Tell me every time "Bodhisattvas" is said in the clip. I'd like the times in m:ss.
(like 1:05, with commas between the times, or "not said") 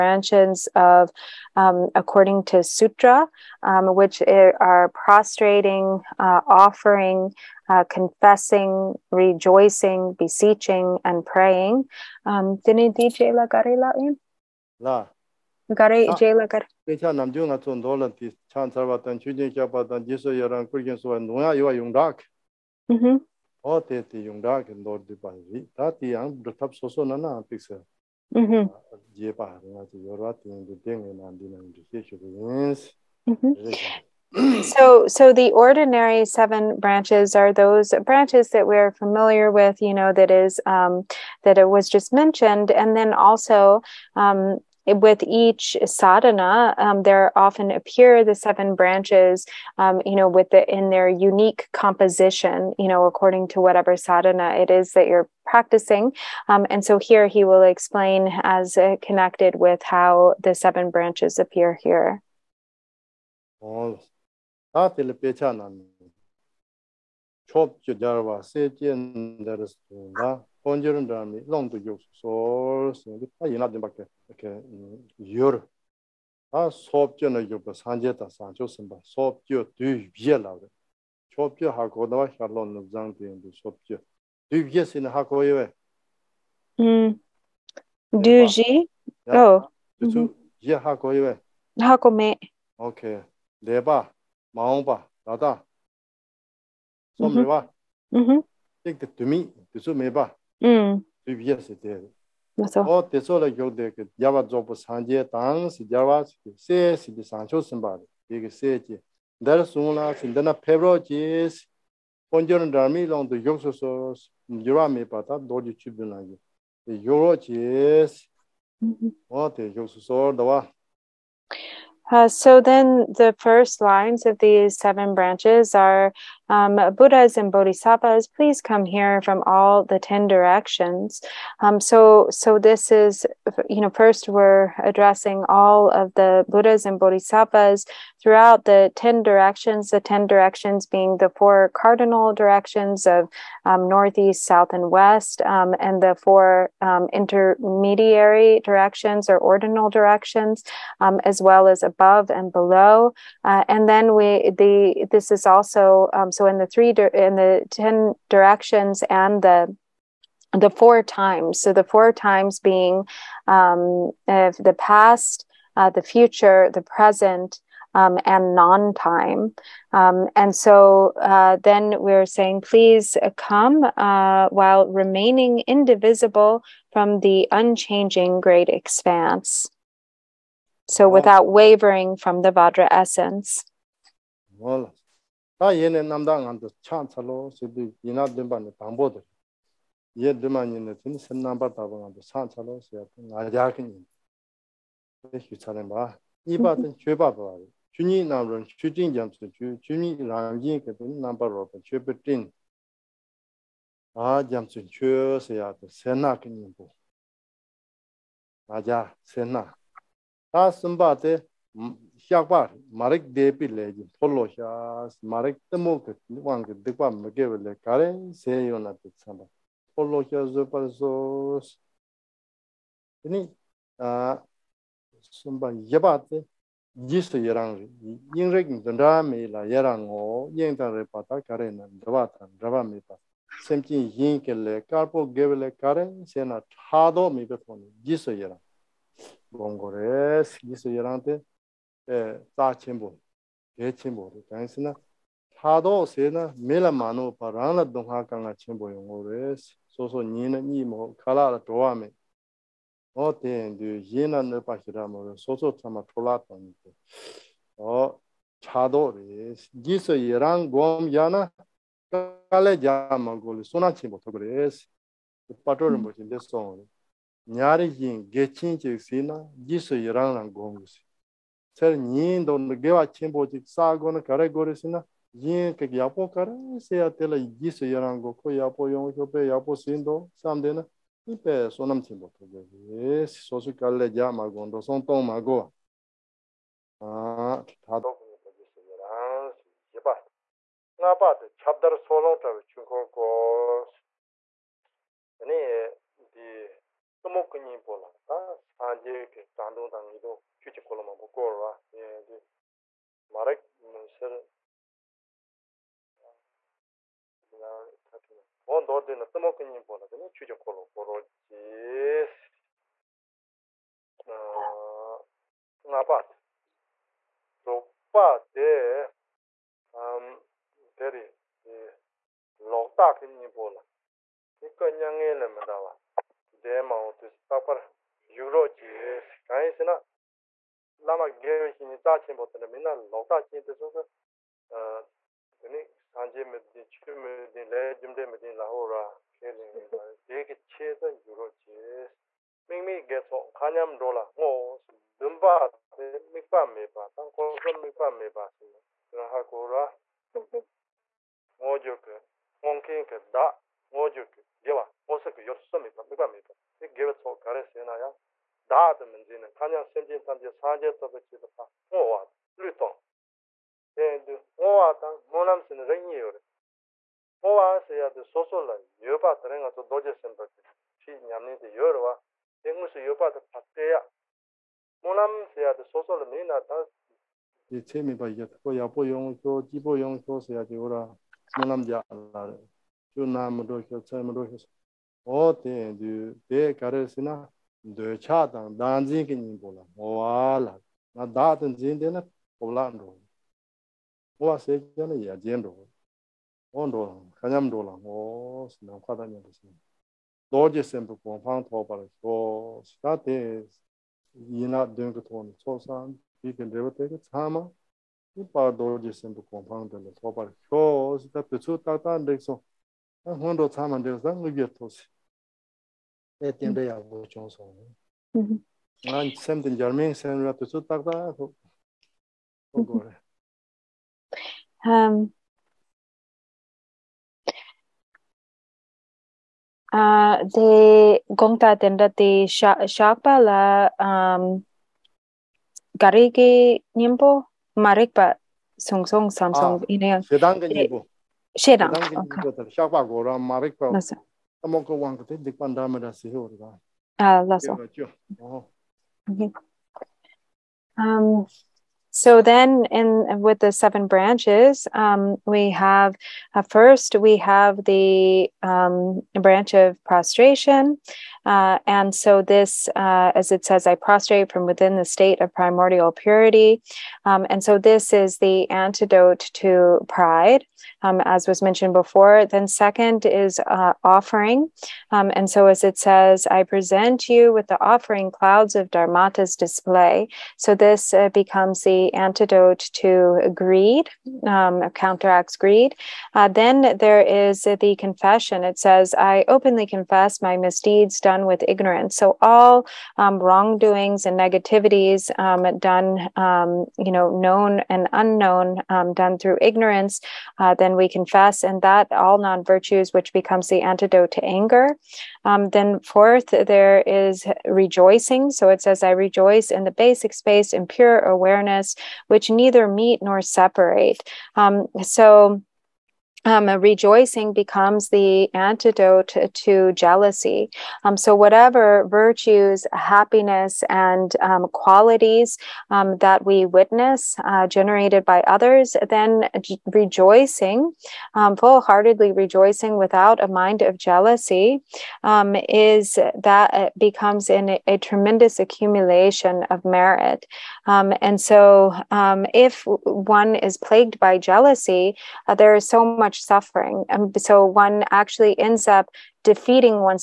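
2:07, 2:17.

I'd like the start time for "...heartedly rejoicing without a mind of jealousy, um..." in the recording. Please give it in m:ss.
8:51.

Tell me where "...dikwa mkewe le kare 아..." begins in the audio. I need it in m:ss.
3:36.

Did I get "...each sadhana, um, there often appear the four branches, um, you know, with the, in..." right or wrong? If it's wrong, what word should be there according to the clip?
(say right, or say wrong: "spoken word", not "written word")
wrong: "seven", not "four".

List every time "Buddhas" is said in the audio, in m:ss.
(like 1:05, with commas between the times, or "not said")
2:06, 2:16.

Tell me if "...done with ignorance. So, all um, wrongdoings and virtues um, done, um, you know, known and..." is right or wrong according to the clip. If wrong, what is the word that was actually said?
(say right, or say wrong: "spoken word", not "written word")
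wrong: "negativities", not "virtues".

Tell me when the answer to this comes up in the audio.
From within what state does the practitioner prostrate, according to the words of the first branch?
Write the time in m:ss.
7:45.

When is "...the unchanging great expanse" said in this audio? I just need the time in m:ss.
2:57.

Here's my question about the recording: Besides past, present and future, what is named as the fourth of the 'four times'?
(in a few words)
Non time.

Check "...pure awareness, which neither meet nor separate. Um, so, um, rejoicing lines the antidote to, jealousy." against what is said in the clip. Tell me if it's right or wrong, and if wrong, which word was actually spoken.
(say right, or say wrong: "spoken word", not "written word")
wrong: "becomes", not "lines".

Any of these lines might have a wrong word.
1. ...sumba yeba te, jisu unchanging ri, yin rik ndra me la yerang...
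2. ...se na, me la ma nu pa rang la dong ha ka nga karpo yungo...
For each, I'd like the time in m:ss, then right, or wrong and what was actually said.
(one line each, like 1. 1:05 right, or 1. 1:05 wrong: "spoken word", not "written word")
1. 3:45 wrong: "yerang", not "unchanging"
2. 4:06 wrong: "chenpo", not "karpo".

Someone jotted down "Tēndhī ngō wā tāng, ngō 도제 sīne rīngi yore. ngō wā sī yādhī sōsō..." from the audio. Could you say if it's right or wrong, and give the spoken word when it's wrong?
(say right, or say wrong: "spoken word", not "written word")
right.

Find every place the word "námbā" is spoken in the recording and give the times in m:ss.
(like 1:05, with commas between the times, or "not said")
3:11, 3:18.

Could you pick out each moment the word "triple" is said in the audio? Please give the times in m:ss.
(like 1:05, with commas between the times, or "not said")
not said.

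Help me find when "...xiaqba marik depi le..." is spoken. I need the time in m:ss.
3:32.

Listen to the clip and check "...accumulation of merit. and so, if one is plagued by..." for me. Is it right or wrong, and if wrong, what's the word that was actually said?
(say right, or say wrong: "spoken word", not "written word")
right.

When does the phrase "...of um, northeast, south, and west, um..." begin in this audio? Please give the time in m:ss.
2:23.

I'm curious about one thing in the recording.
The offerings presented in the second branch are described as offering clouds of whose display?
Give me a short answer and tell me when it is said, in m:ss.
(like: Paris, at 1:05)
Dharmata's, at 7:58.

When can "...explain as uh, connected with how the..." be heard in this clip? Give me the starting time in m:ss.
0:57.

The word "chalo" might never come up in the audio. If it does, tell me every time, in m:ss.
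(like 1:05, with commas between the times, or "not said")
3:07, 3:12.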